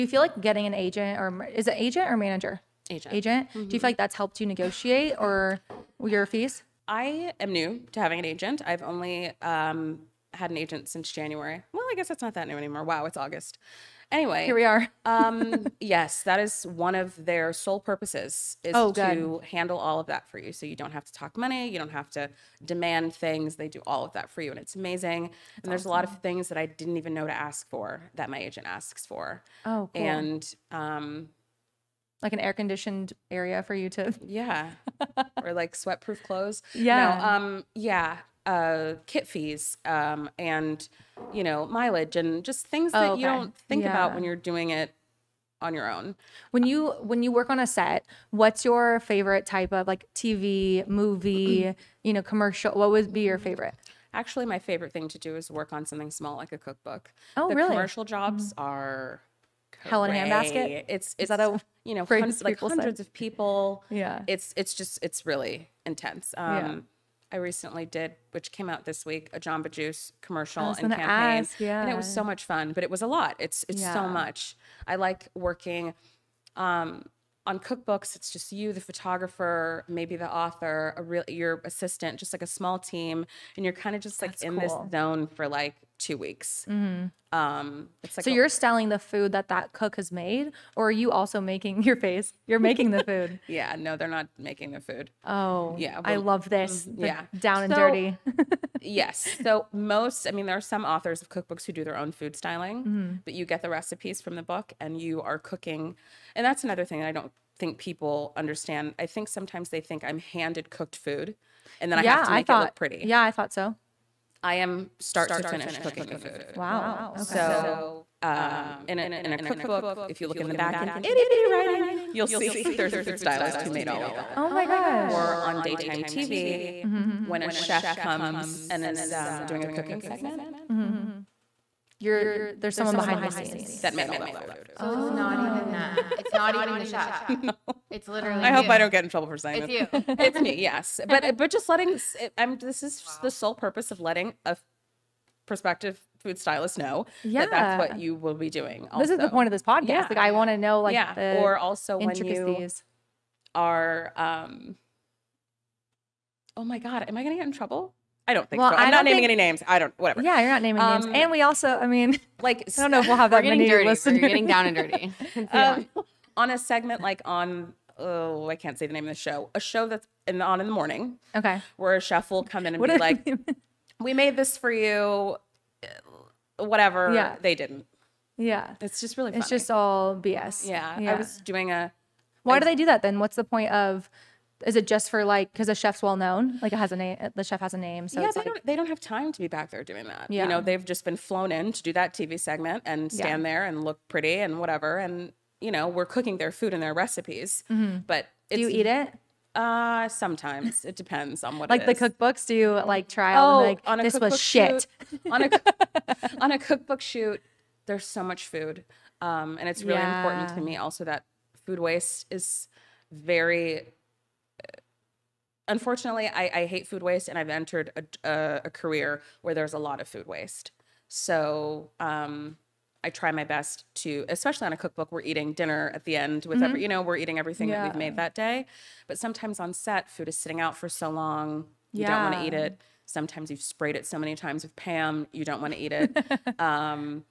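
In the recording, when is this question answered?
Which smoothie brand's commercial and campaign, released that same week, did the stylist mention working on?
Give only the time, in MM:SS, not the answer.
01:09.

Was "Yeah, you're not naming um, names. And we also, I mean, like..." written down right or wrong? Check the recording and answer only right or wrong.
right.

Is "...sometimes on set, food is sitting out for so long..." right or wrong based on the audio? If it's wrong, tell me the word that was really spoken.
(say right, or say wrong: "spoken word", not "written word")
right.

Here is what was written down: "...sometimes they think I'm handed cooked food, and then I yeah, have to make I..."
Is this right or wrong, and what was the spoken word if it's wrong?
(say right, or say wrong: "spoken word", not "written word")
right.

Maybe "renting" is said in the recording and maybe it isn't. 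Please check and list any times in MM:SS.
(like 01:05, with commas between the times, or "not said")
not said.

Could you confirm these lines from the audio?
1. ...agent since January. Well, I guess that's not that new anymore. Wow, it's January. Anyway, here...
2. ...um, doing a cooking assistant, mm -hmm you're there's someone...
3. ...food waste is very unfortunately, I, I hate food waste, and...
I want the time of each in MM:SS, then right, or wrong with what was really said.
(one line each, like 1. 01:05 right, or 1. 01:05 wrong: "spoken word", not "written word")
1. 00:10 wrong: "August", not "January"
2. 02:09 wrong: "segment", not "assistant"
3. 03:31 right.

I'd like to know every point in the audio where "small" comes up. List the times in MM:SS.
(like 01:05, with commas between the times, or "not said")
00:56, 01:22.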